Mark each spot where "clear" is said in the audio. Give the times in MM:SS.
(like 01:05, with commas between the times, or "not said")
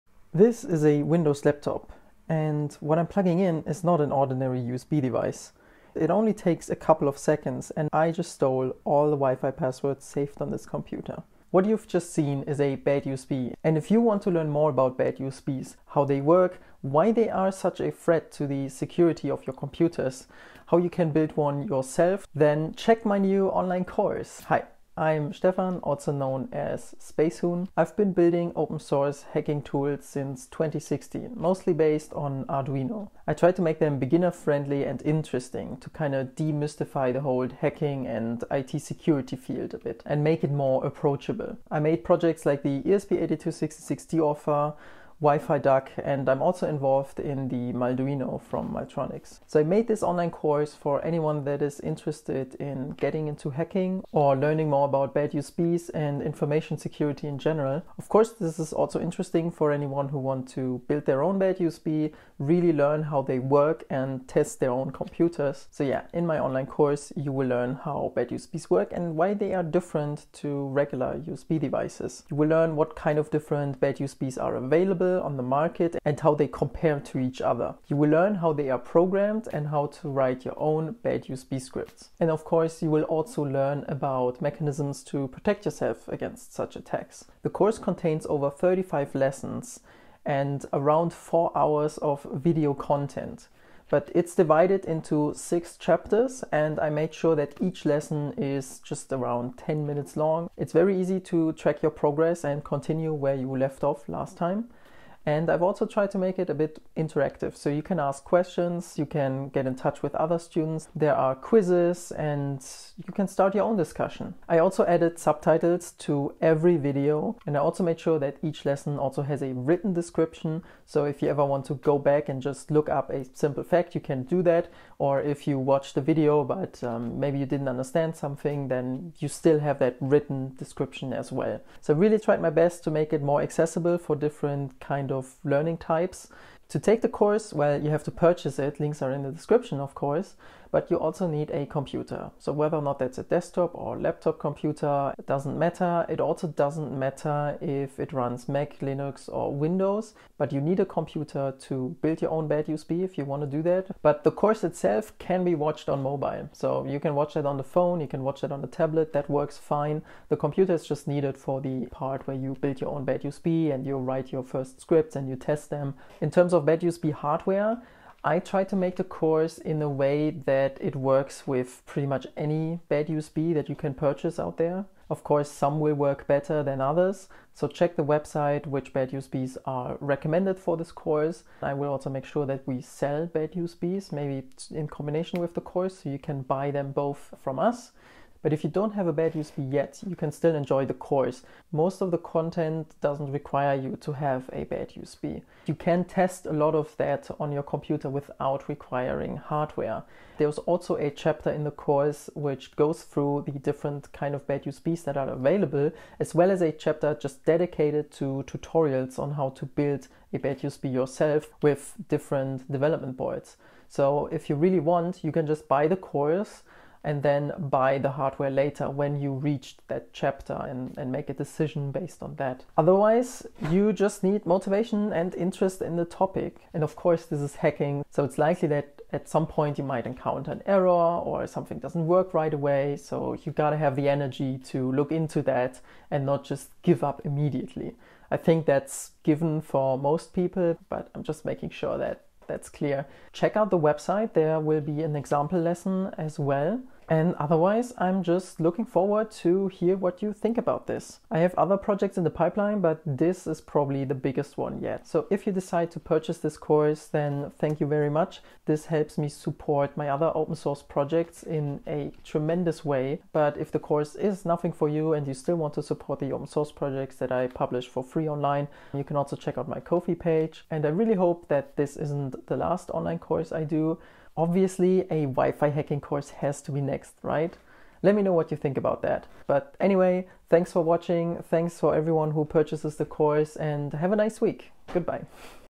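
04:02.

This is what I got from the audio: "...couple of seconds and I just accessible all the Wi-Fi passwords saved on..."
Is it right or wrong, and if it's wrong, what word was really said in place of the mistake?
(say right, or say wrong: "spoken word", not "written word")
wrong: "stole", not "accessible".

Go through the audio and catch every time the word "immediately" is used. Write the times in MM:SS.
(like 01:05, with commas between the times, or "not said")
03:57.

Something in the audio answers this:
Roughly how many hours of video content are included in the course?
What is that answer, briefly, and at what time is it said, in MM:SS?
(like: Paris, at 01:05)
4, at 01:31.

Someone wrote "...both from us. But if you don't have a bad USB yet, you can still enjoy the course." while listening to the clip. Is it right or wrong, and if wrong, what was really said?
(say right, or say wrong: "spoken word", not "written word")
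right.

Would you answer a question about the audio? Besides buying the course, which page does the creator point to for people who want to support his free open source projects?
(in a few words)
Ko-fi.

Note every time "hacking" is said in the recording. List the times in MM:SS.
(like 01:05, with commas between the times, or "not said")
00:29, 00:37, 00:53, 03:47, 04:35.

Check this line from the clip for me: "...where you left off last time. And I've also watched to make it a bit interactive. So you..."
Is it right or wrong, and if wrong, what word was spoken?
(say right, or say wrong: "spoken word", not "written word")
wrong: "tried", not "watched".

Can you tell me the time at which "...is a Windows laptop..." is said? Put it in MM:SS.
00:00.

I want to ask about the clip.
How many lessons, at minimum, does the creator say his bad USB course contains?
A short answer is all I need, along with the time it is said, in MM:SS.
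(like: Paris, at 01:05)
35, at 01:28.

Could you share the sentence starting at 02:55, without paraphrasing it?
Of course, some will work better than others, so check the website which bad USBs are recommended for this course.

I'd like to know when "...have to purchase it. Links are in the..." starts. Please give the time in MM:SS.
02:17.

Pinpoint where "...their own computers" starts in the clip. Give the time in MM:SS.
01:04.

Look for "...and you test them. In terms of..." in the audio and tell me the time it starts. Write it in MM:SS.
02:45.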